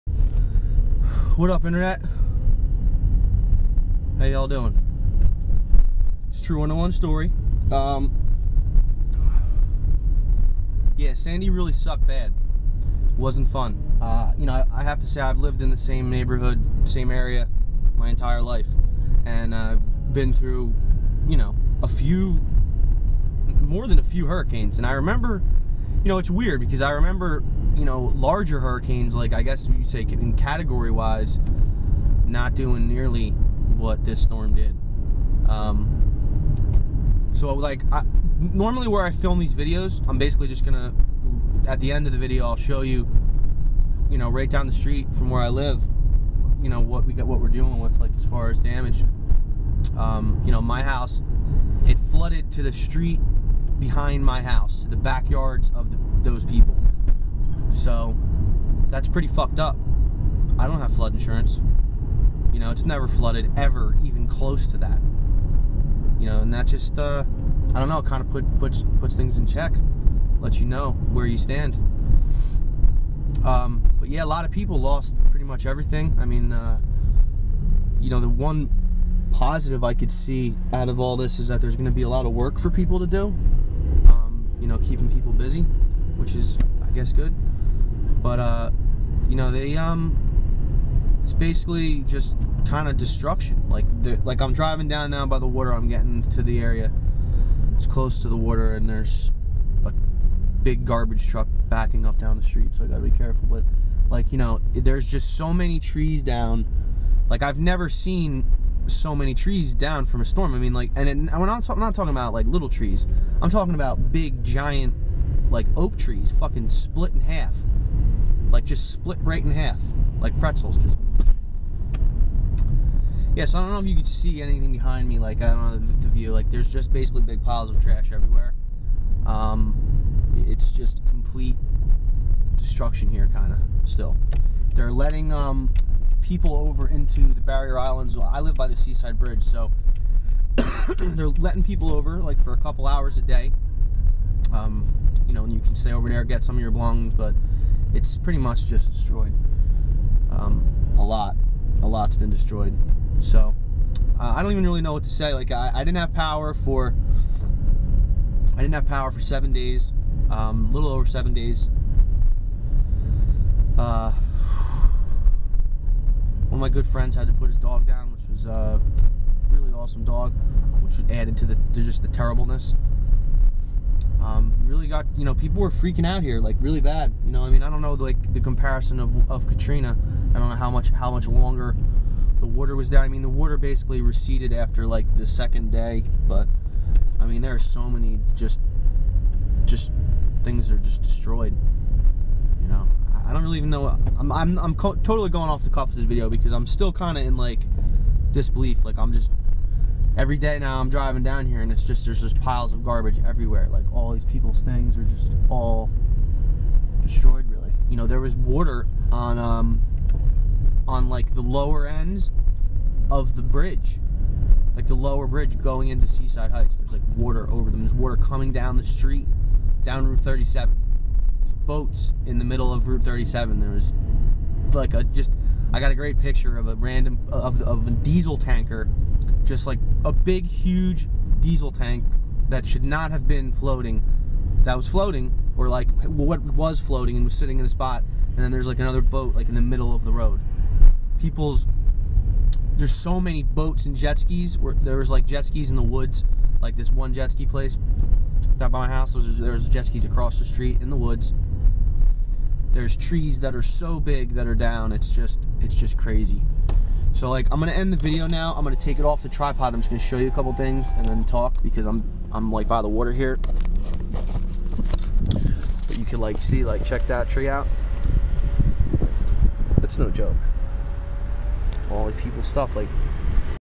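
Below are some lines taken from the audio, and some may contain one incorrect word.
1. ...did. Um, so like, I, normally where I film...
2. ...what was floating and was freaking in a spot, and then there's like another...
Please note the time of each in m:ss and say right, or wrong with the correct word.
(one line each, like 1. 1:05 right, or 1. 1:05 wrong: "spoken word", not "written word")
1. 0:34 right
2. 3:56 wrong: "sitting", not "freaking".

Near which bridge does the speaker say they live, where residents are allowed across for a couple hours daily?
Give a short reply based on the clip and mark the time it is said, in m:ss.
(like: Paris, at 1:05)
Seaside bridge, at 2:18.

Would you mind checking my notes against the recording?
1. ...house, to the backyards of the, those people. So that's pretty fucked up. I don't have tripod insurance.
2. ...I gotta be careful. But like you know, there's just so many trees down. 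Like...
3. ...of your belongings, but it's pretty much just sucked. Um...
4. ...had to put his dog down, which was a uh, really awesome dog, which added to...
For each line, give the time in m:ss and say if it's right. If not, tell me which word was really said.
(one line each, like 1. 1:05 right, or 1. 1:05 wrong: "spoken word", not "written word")
1. 0:54 wrong: "flood", not "tripod"
2. 1:42 right
3. 2:26 wrong: "destroyed", not "sucked"
4. 2:47 right.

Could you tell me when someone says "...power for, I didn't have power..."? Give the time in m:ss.
2:36.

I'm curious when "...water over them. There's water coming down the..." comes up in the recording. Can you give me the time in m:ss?
3:37.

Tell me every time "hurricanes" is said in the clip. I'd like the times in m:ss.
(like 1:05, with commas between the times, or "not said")
0:24, 0:28.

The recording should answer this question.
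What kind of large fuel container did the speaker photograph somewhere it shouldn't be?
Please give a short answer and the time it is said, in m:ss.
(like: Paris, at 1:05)
diesel tanker, at 3:47.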